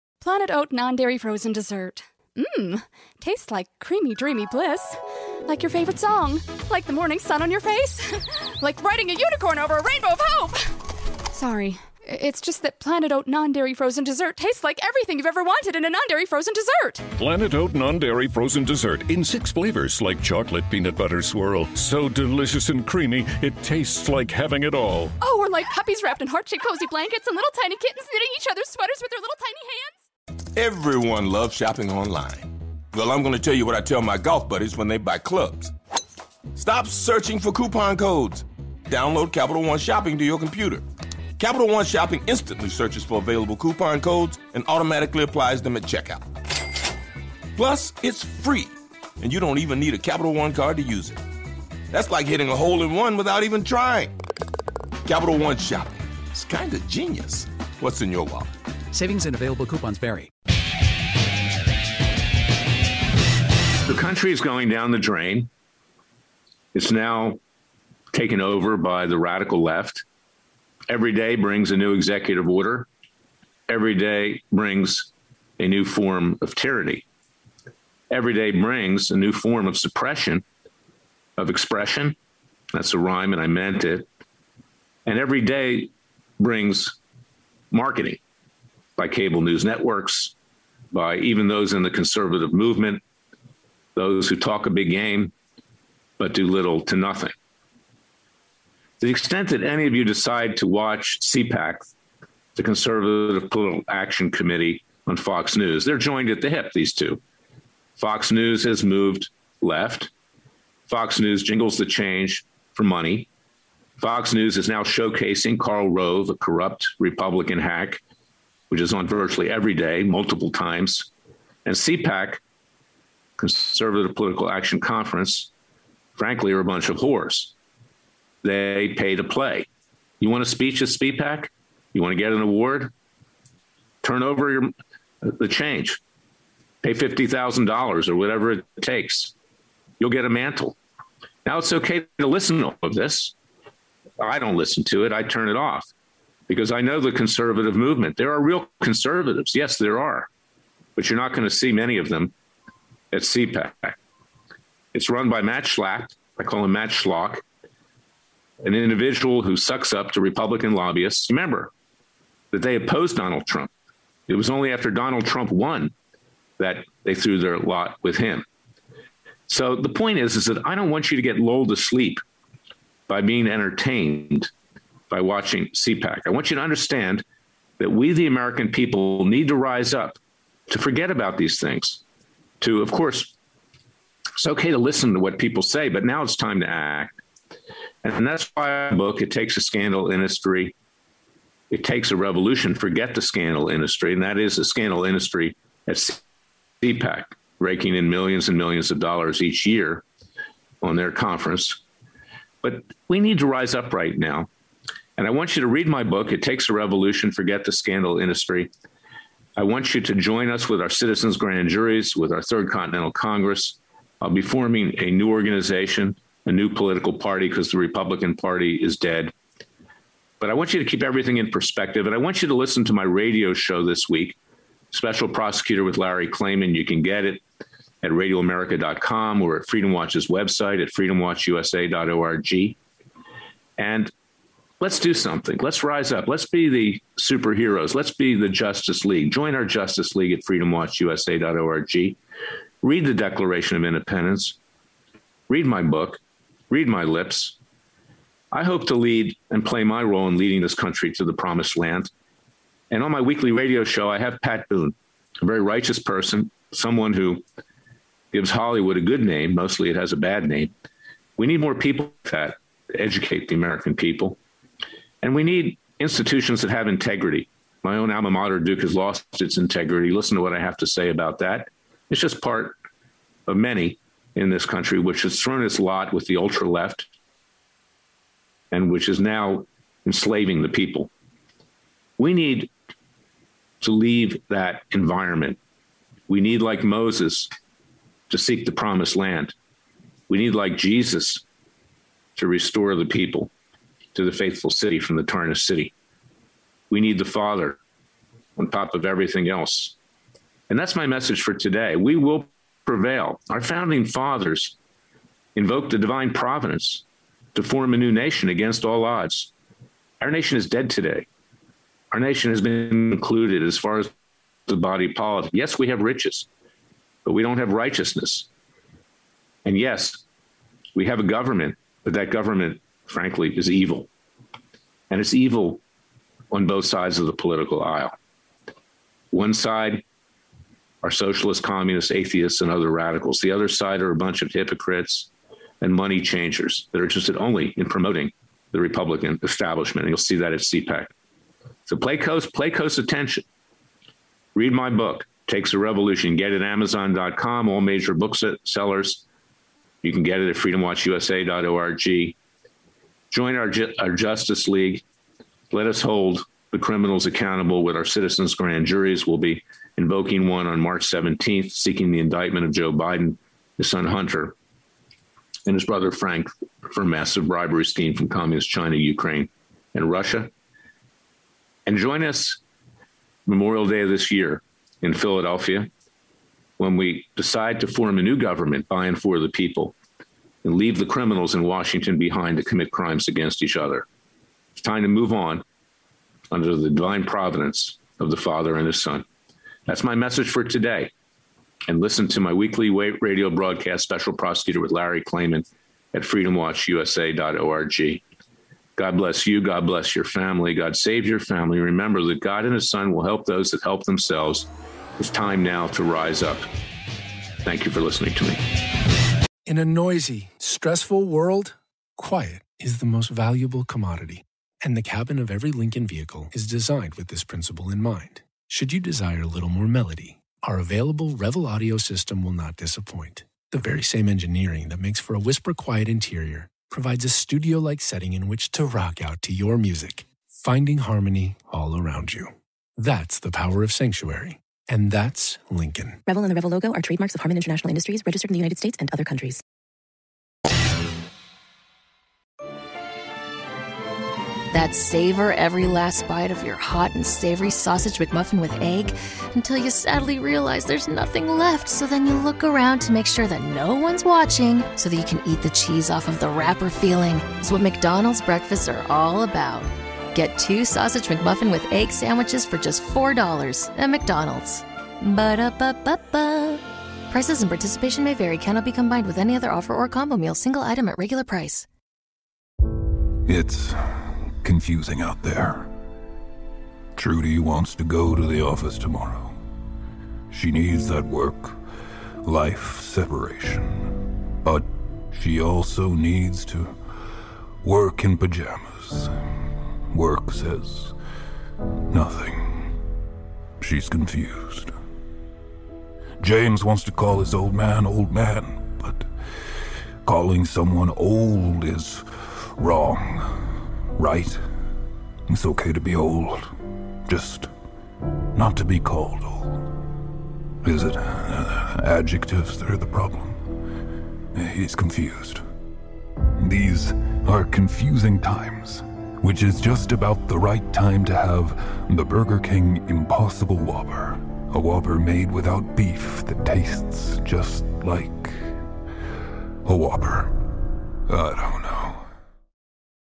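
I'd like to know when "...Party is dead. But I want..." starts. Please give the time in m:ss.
3:38.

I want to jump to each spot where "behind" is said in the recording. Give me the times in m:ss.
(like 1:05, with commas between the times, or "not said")
6:22.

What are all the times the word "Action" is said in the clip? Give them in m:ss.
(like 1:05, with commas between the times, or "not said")
1:43, 2:04.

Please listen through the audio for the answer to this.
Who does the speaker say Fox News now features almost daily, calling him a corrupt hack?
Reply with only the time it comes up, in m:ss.
1:55.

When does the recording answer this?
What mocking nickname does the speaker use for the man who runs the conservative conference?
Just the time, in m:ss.
2:36.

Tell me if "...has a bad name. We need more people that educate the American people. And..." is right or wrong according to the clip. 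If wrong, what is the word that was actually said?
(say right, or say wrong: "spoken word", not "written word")
right.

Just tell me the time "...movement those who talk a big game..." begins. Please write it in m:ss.
1:32.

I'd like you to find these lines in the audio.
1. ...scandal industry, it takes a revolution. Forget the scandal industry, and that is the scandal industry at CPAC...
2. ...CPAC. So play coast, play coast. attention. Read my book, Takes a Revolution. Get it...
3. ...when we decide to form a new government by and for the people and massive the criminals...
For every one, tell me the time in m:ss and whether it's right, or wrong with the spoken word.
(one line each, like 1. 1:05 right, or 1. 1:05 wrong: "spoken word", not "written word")
1. 3:09 right
2. 5:40 right
3. 6:16 wrong: "leave", not "massive".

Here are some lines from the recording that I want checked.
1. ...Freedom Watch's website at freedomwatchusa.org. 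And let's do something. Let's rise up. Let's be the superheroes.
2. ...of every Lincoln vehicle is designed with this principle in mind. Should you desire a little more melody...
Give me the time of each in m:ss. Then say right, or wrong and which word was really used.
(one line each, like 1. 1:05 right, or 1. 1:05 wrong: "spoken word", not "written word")
1. 3:49 right
2. 6:55 right.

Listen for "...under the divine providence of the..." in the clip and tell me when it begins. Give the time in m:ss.
6:26.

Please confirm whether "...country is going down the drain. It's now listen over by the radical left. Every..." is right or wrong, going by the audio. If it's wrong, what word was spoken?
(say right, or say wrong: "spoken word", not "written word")
wrong: "taken", not "listen".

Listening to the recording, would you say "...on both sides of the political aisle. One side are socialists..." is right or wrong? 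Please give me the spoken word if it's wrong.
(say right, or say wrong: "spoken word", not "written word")
right.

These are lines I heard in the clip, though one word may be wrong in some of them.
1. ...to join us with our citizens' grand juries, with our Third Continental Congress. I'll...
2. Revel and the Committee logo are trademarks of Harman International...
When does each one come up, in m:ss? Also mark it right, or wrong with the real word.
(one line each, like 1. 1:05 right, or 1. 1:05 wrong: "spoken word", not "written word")
1. 3:30 right
2. 7:16 wrong: "Revel", not "Committee".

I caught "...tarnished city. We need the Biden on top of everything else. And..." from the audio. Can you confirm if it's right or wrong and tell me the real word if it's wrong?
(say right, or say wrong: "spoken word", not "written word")
wrong: "Father", not "Biden".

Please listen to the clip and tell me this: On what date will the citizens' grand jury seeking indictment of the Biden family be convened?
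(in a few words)
March 17.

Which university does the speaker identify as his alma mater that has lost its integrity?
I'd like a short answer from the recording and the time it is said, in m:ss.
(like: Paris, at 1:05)
Duke, at 4:28.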